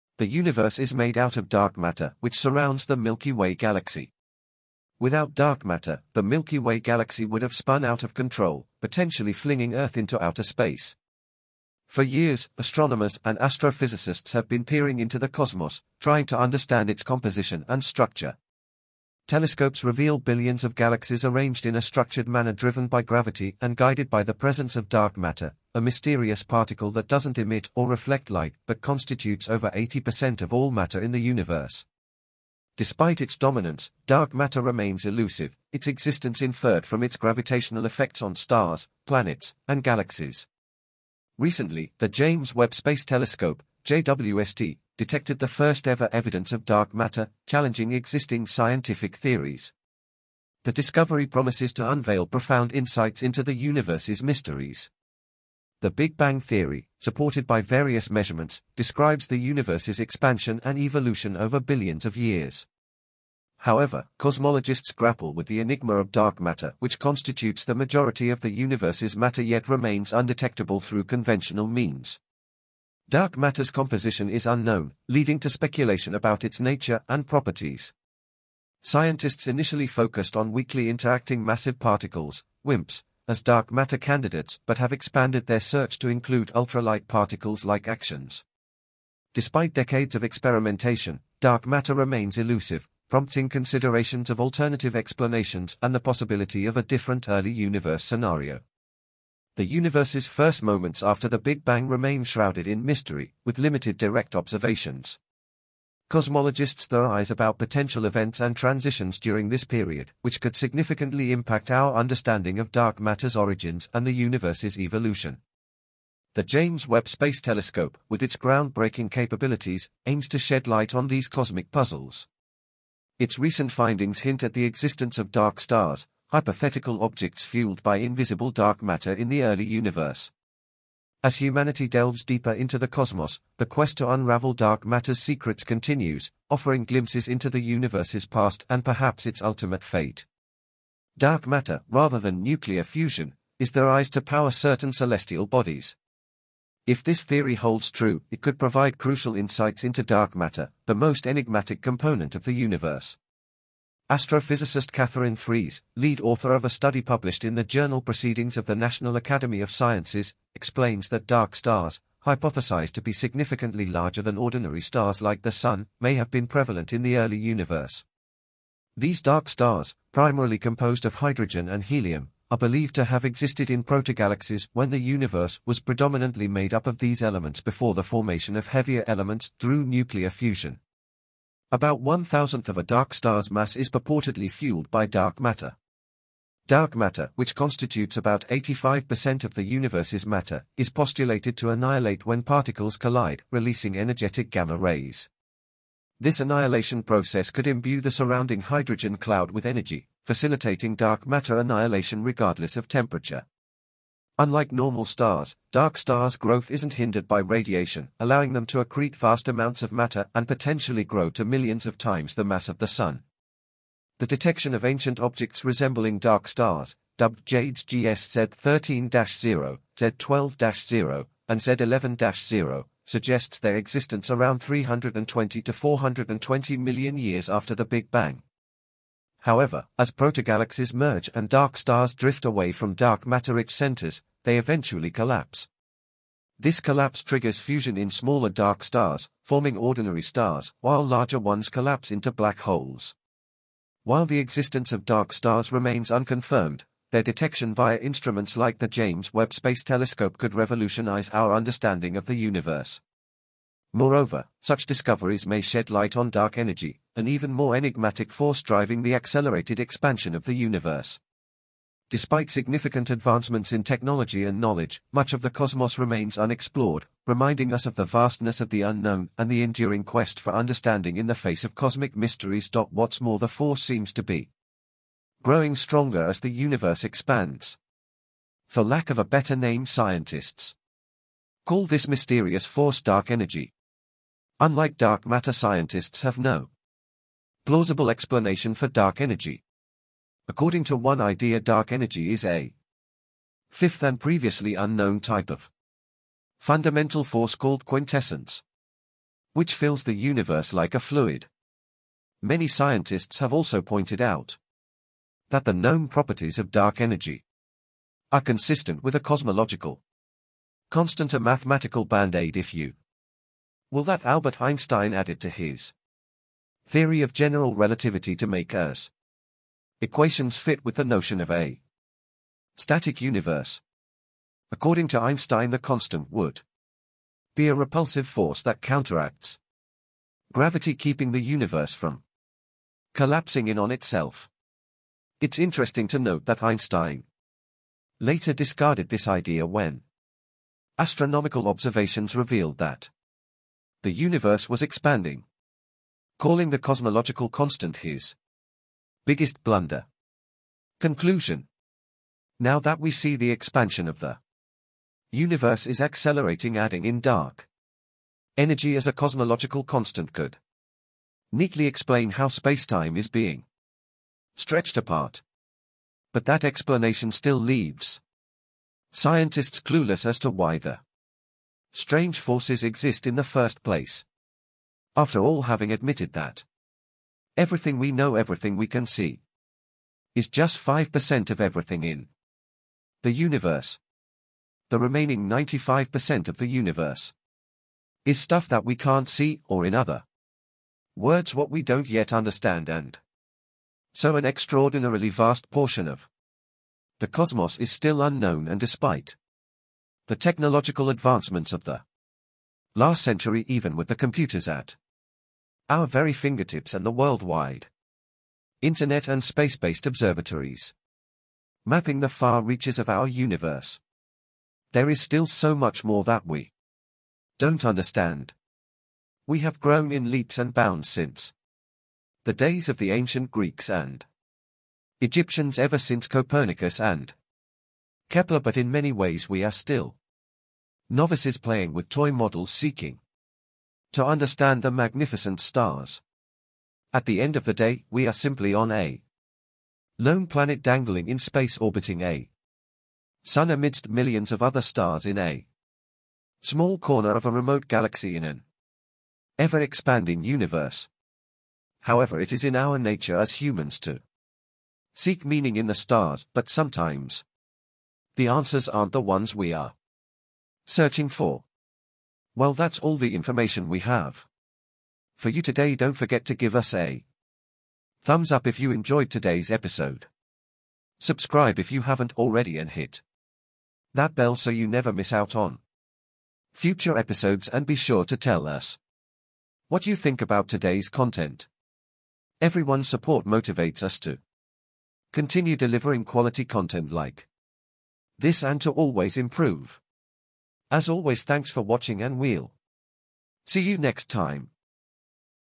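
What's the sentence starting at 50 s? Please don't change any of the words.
The discovery promises to unveil profound insights into the universe's mysteries.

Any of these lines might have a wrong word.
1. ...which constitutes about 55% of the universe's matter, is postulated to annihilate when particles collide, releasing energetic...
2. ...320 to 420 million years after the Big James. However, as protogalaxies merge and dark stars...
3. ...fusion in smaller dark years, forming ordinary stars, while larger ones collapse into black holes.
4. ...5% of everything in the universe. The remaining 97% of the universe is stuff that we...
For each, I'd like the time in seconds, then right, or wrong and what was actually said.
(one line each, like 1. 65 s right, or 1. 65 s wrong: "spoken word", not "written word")
1. 187 s wrong: "85", not "55"
2. 224 s wrong: "Bang", not "James"
3. 237 s wrong: "stars", not "years"
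4. 380 s wrong: "95", not "97".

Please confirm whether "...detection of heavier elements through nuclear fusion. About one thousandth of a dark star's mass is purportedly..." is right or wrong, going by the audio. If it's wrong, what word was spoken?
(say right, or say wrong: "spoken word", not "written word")
wrong: "formation", not "detection".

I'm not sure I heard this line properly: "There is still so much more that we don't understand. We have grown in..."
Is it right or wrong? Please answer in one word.
right.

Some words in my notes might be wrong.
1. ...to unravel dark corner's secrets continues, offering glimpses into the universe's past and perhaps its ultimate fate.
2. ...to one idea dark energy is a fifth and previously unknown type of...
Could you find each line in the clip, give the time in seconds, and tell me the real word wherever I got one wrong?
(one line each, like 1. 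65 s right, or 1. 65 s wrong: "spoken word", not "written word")
1. 133 s wrong: "matter", not "corner"
2. 290 s right.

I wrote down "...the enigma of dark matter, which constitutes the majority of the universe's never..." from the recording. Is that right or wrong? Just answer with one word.
wrong.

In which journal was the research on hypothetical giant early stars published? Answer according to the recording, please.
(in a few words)
Proceedings of the National Academy of Sciences.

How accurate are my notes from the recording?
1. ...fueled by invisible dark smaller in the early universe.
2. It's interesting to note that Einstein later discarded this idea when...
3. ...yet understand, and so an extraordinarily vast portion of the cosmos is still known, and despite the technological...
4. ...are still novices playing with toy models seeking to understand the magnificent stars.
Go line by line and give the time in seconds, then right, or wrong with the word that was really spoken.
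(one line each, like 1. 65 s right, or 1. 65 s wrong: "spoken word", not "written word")
1. 127 s wrong: "matter", not "smaller"
2. 335 s right
3. 392 s wrong: "unknown", not "known"
4. 429 s right.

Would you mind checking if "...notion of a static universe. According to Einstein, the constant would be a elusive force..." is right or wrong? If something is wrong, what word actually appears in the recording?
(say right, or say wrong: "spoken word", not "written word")
wrong: "repulsive", not "elusive".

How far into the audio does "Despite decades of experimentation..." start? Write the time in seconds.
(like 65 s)
89 s.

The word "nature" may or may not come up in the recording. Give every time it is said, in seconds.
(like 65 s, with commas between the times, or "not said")
76 s, 452 s.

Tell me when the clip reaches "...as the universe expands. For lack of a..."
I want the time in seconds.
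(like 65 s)
276 s.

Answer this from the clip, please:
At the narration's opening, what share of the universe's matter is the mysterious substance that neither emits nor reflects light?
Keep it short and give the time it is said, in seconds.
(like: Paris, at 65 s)
over 80%, at 29 s.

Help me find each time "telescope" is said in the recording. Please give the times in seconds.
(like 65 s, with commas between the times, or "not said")
19 s, 43 s, 117 s, 249 s.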